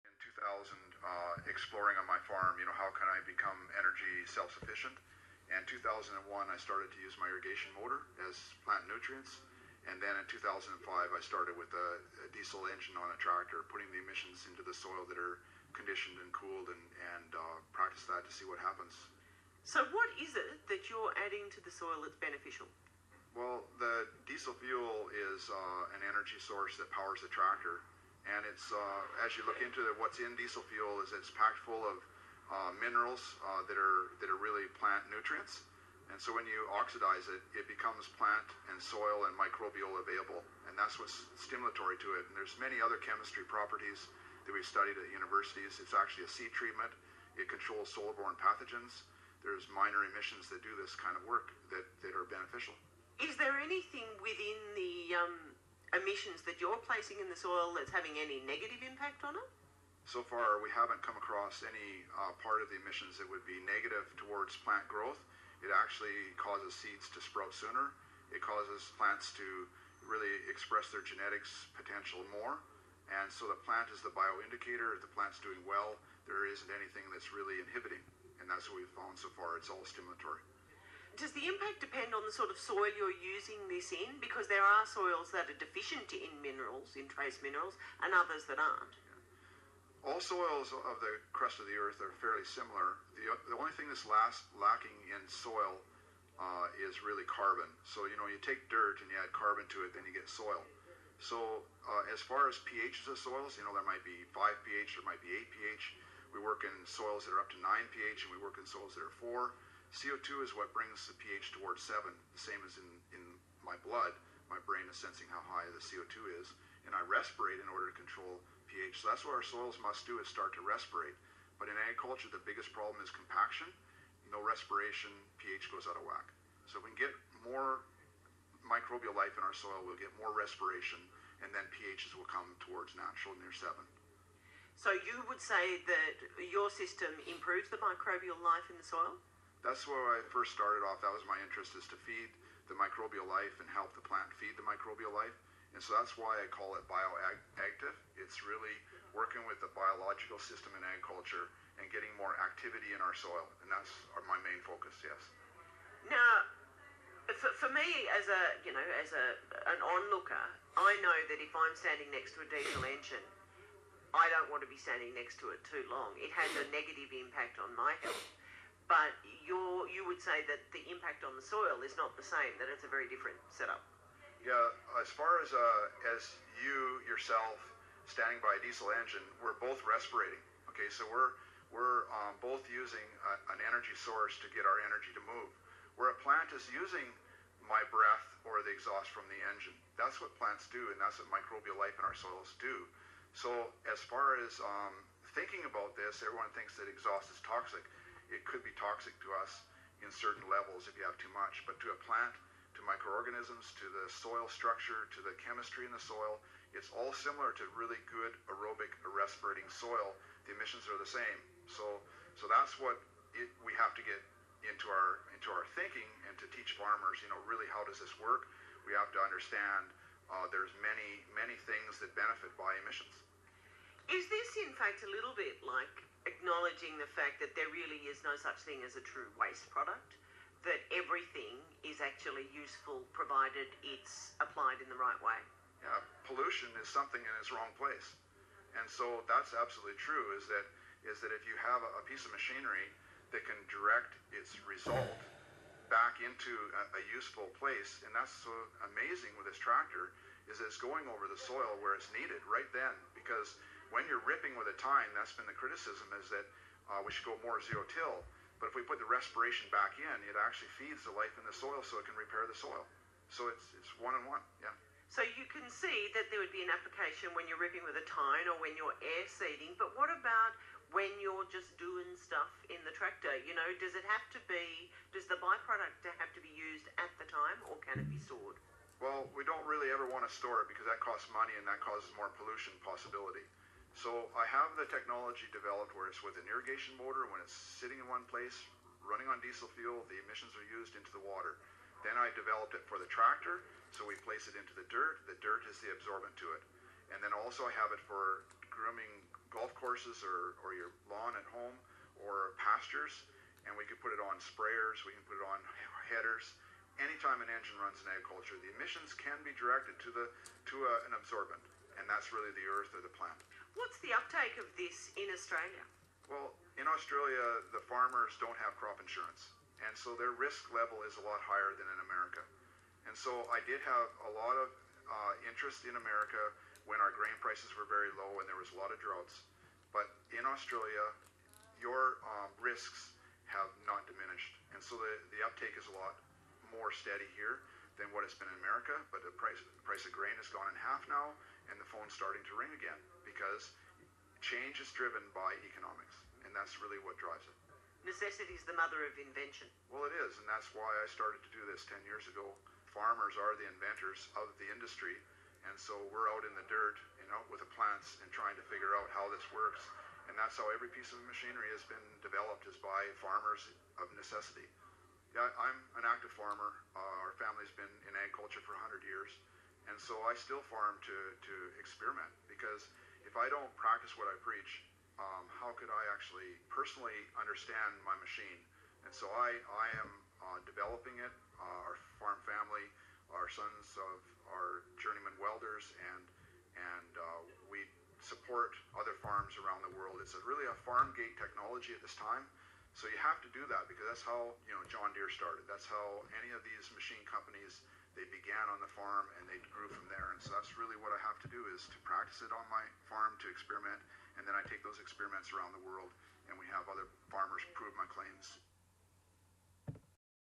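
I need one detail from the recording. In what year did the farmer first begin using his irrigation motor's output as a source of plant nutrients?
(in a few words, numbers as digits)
2001.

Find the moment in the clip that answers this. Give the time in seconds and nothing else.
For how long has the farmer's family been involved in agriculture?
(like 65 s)
368 s.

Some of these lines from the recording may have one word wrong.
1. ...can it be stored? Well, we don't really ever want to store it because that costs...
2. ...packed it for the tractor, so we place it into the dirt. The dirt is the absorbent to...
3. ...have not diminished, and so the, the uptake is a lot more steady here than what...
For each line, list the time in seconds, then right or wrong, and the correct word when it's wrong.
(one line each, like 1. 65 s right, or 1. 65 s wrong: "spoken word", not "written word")
1. 277 s right
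2. 292 s wrong: "developed", not "packed"
3. 333 s right.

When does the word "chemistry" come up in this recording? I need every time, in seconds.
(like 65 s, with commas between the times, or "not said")
43 s, 205 s.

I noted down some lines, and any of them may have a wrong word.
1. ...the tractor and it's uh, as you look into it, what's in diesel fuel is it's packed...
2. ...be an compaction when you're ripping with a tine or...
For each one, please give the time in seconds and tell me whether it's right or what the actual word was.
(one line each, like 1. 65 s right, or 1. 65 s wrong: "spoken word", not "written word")
1. 27 s right
2. 266 s wrong: "application", not "compaction".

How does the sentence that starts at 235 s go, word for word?
Yeah, pollution is something in its wrong place.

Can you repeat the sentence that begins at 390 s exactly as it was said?
It's a, really a farm gate technology at this time.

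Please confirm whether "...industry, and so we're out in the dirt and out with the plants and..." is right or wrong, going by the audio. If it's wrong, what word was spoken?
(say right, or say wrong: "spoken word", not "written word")
right.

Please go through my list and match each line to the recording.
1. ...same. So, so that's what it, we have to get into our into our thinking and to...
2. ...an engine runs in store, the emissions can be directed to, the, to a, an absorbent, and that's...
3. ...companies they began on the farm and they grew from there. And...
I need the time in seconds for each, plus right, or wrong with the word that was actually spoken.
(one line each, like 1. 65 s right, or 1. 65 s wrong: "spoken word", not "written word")
1. 211 s right
2. 307 s wrong: "agriculture", not "store"
3. 397 s right.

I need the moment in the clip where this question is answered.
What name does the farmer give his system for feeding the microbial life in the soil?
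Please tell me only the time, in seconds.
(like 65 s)
146 s.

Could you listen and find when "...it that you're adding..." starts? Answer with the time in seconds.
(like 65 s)
20 s.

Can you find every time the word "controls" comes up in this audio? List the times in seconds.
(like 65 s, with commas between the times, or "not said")
47 s, 117 s.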